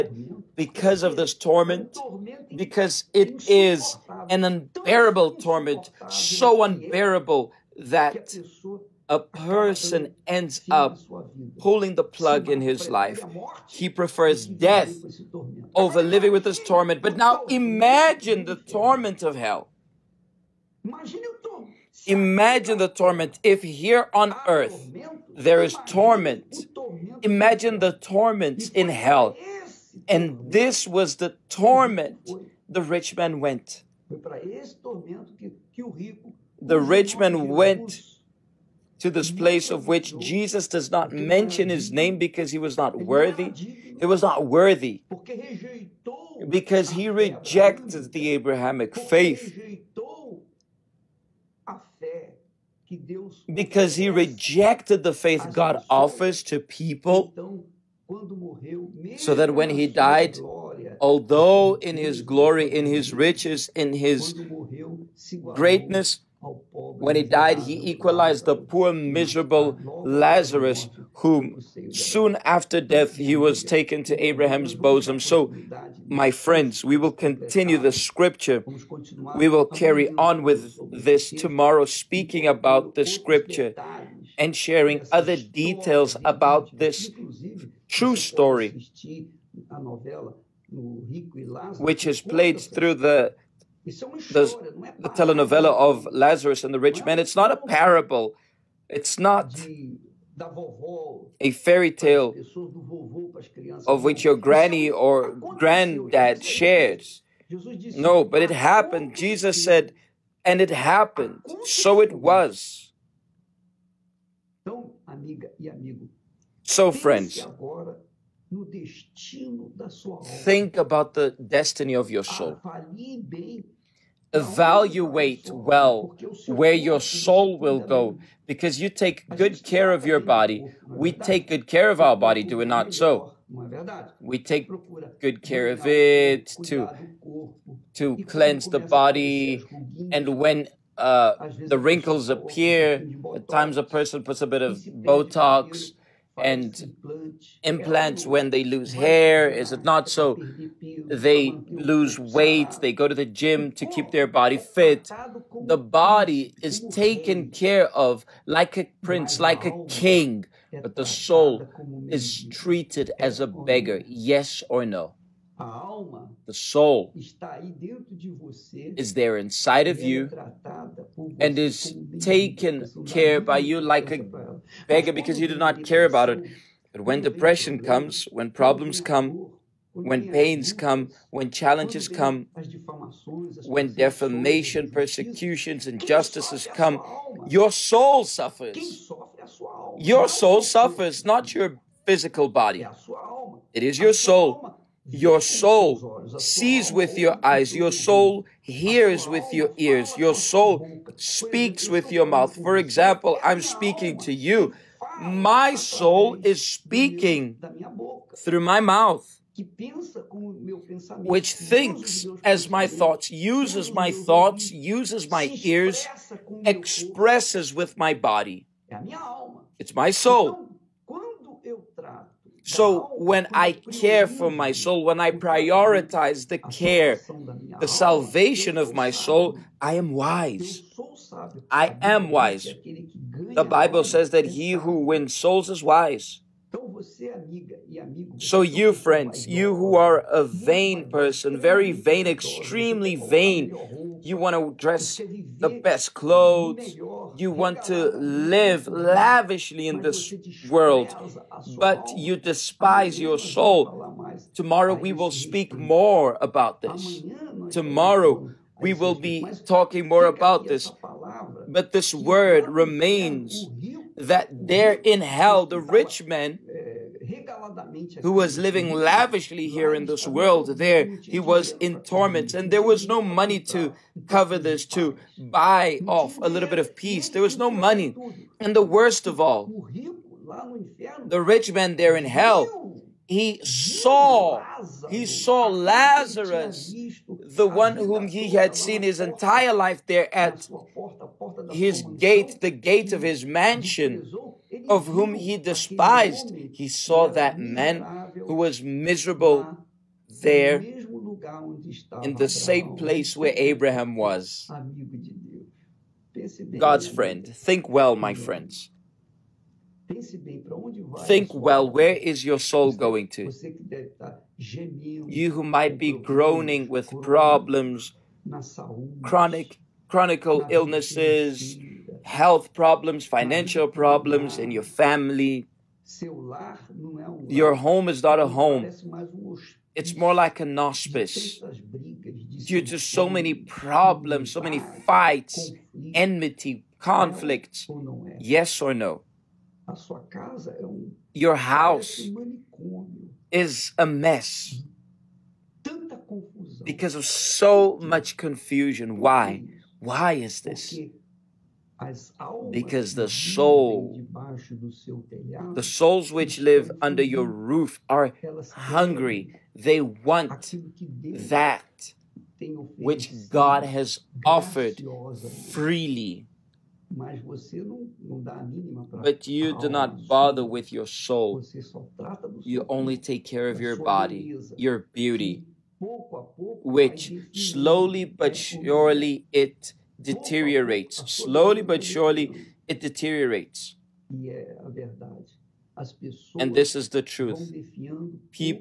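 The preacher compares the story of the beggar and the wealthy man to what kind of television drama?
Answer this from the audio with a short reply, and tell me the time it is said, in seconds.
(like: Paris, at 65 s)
telenovela, at 95 s.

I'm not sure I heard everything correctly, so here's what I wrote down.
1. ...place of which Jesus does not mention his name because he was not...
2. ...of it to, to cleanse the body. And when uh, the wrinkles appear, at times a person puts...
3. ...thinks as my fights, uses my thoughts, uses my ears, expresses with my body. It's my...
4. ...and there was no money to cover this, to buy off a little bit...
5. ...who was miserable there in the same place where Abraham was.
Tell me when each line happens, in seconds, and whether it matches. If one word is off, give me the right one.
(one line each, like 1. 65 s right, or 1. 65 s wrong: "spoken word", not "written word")
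1. 39 s right
2. 135 s right
3. 211 s wrong: "thoughts", not "fights"
4. 272 s right
5. 298 s right.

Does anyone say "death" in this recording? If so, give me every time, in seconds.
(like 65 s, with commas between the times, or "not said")
14 s, 72 s.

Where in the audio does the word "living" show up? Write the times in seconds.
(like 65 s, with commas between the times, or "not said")
16 s, 268 s.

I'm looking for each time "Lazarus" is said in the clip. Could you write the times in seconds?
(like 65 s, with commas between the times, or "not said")
70 s, 96 s, 285 s.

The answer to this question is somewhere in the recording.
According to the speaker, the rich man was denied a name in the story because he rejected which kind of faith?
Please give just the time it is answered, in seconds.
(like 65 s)
48 s.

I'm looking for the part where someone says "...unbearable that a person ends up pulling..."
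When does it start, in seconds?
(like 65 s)
6 s.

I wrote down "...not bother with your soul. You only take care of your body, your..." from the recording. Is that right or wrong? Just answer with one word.
right.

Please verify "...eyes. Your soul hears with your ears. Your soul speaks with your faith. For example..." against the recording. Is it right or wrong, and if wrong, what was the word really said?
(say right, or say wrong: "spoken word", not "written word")
wrong: "mouth", not "faith".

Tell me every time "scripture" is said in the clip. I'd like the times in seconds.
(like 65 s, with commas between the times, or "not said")
77 s, 83 s.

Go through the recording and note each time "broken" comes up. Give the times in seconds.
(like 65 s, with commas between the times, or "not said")
not said.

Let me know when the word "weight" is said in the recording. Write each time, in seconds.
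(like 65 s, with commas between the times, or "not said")
152 s.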